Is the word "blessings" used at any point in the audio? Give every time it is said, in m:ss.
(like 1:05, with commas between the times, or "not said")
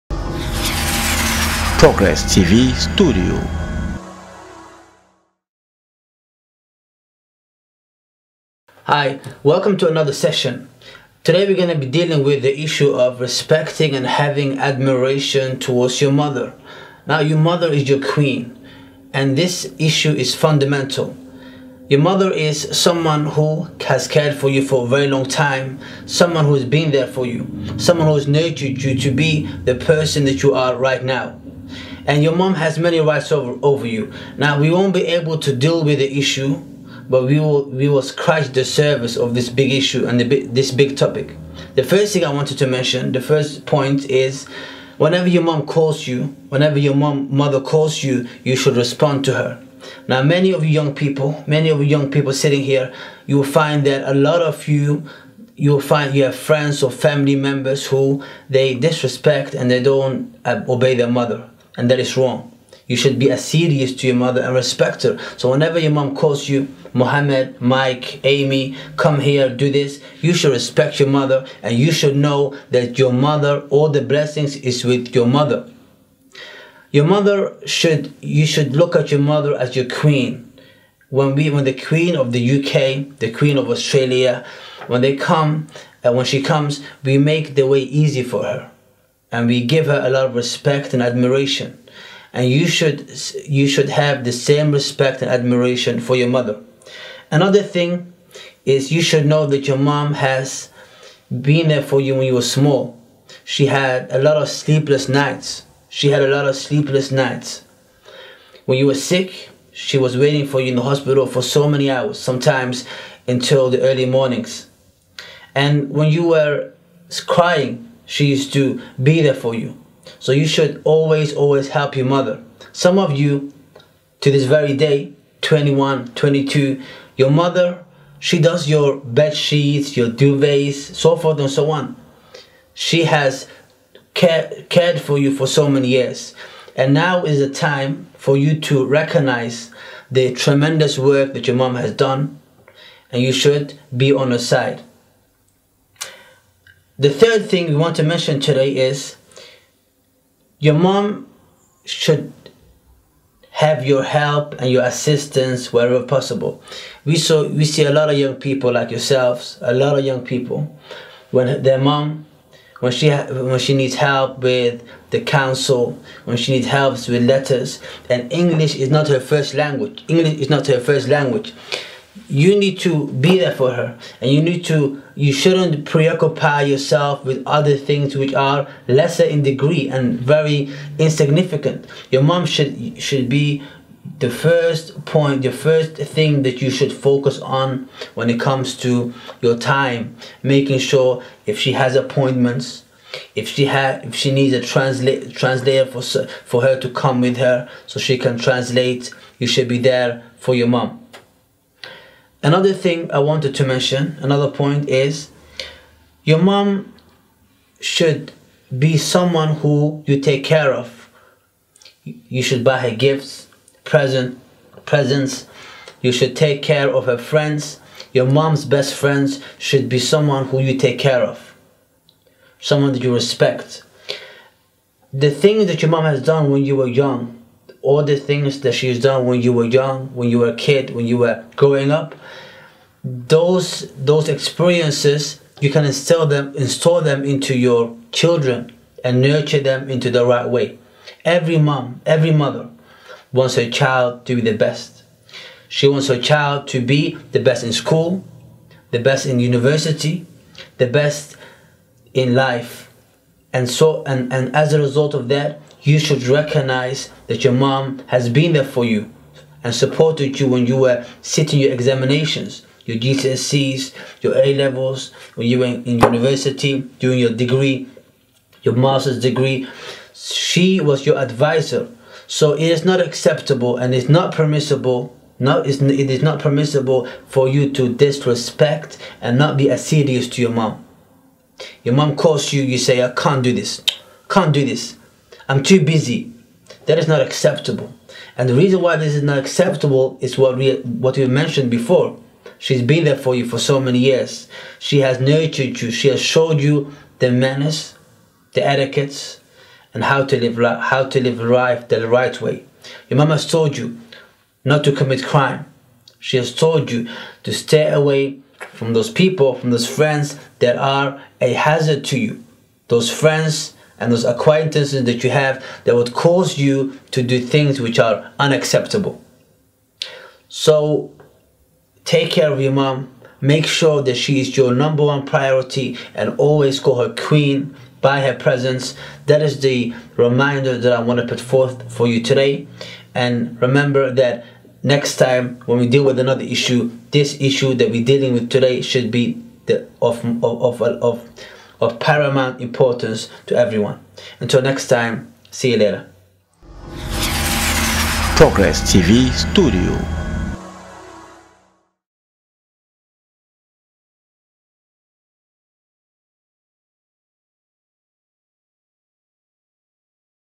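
1:14.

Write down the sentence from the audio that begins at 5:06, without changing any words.
She has told you to stay away from those people, from those friends that are a hazard to you.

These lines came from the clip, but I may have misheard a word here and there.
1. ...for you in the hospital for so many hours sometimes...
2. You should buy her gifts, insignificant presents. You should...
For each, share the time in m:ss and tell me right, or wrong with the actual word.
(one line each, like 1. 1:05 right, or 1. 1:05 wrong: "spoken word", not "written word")
1. 1:50 right
2. 3:32 wrong: "present", not "insignificant".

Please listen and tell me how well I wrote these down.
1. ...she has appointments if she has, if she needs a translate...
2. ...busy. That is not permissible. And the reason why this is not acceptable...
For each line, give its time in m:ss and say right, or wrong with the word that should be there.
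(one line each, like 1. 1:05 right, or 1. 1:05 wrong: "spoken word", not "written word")
1. 3:11 right
2. 4:45 wrong: "acceptable", not "permissible".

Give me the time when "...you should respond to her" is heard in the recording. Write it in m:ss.
0:48.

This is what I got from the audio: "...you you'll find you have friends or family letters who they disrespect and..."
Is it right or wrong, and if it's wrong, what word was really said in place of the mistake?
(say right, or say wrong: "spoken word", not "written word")
wrong: "members", not "letters".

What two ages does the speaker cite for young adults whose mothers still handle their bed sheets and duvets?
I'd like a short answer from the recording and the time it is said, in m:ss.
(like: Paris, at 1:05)
21, 22, at 2:05.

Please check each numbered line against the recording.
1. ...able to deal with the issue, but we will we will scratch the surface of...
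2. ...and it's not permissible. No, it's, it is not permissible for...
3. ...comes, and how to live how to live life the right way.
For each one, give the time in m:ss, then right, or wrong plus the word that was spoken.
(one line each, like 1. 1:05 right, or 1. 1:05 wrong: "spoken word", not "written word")
1. 0:35 right
2. 4:33 right
3. 4:58 wrong: "etiquettes", not "comes".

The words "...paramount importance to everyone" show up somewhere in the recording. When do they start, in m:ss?
5:41.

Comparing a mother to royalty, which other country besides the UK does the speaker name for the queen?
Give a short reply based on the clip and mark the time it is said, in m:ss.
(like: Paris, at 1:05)
Australia, at 1:23.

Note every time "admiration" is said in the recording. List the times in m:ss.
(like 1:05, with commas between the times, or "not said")
0:14, 1:31, 1:35.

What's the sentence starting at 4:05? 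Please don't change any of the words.
She wants her child to be the best in school, the best in university, the best in life.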